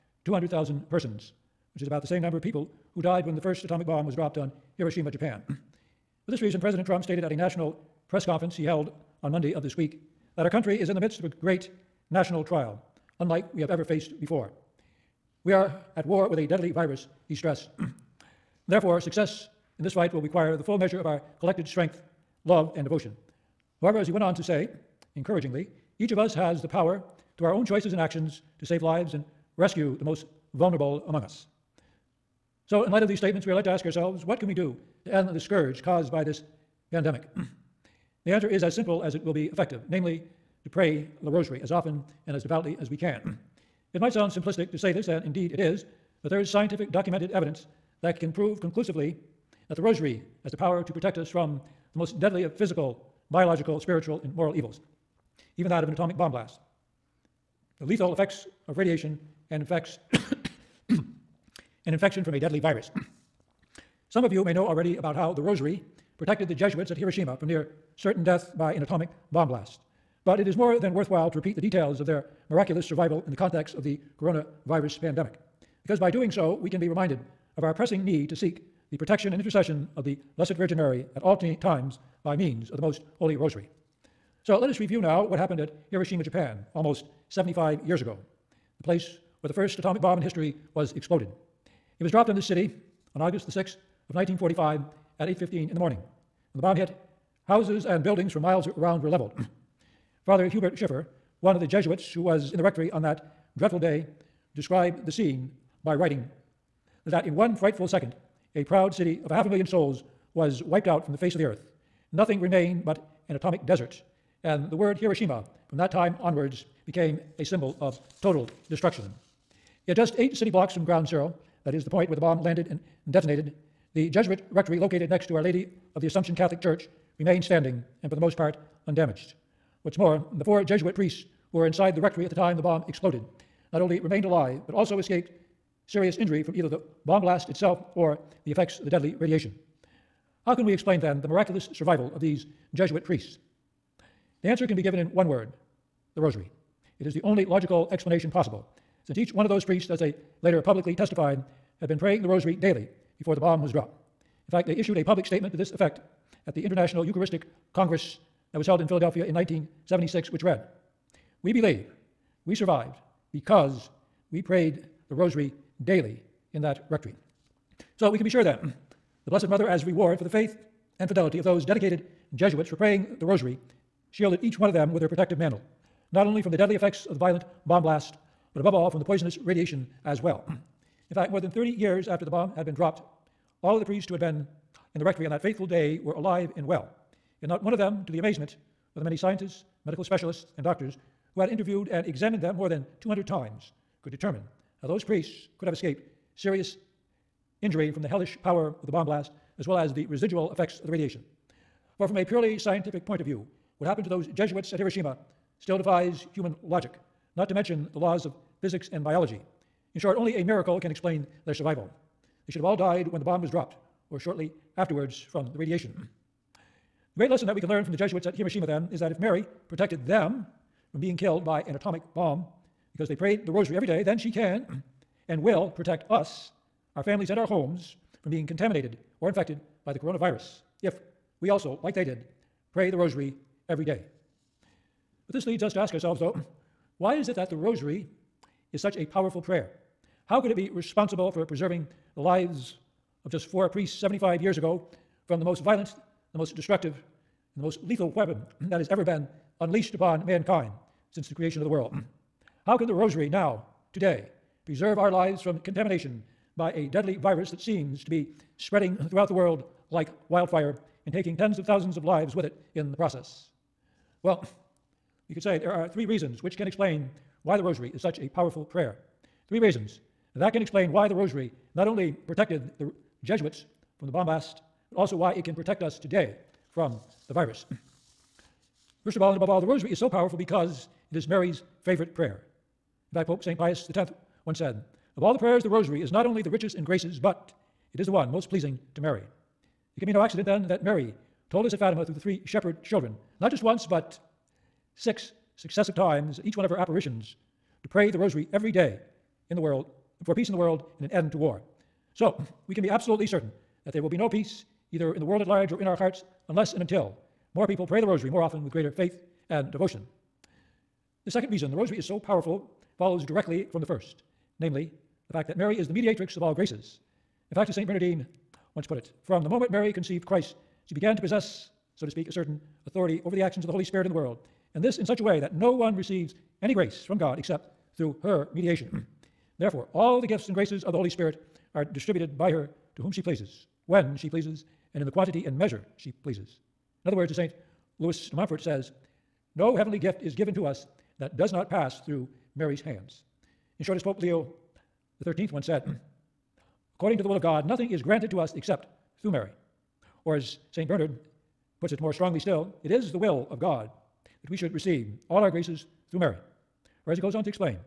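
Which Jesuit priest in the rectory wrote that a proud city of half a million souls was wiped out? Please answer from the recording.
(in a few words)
Father Hubert Schiffer.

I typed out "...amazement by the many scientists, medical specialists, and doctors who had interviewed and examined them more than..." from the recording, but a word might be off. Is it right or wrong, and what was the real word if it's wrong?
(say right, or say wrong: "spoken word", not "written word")
right.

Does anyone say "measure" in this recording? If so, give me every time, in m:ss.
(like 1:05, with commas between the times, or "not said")
0:20, 5:35.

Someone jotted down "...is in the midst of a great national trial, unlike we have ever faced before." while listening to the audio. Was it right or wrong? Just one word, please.
right.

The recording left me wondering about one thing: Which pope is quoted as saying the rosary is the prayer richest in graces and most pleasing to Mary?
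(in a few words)
Pope St. Pius X.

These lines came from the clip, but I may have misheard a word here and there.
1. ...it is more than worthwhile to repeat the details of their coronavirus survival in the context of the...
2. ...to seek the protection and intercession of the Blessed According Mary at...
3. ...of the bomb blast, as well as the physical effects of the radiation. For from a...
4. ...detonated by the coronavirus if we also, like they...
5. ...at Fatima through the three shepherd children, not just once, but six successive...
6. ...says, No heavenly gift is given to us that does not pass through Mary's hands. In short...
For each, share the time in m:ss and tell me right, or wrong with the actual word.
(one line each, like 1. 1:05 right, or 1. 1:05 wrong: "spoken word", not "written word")
1. 1:10 wrong: "miraculous", not "coronavirus"
2. 1:18 wrong: "Virgin", not "According"
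3. 3:18 wrong: "residual", not "physical"
4. 3:49 wrong: "infected", not "detonated"
5. 4:51 right
6. 5:38 right.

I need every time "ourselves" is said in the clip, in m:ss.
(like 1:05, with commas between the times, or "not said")
0:33, 3:55.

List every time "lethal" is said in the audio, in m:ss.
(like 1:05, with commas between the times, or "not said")
0:57, 4:07.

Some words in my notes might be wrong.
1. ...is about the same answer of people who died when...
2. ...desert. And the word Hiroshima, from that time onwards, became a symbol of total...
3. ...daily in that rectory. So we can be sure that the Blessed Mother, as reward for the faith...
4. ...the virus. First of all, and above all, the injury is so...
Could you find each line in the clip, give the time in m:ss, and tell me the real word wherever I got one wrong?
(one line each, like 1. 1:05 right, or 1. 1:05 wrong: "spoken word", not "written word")
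1. 0:01 wrong: "number", not "answer"
2. 1:53 right
3. 2:45 right
4. 4:37 wrong: "rosary", not "injury".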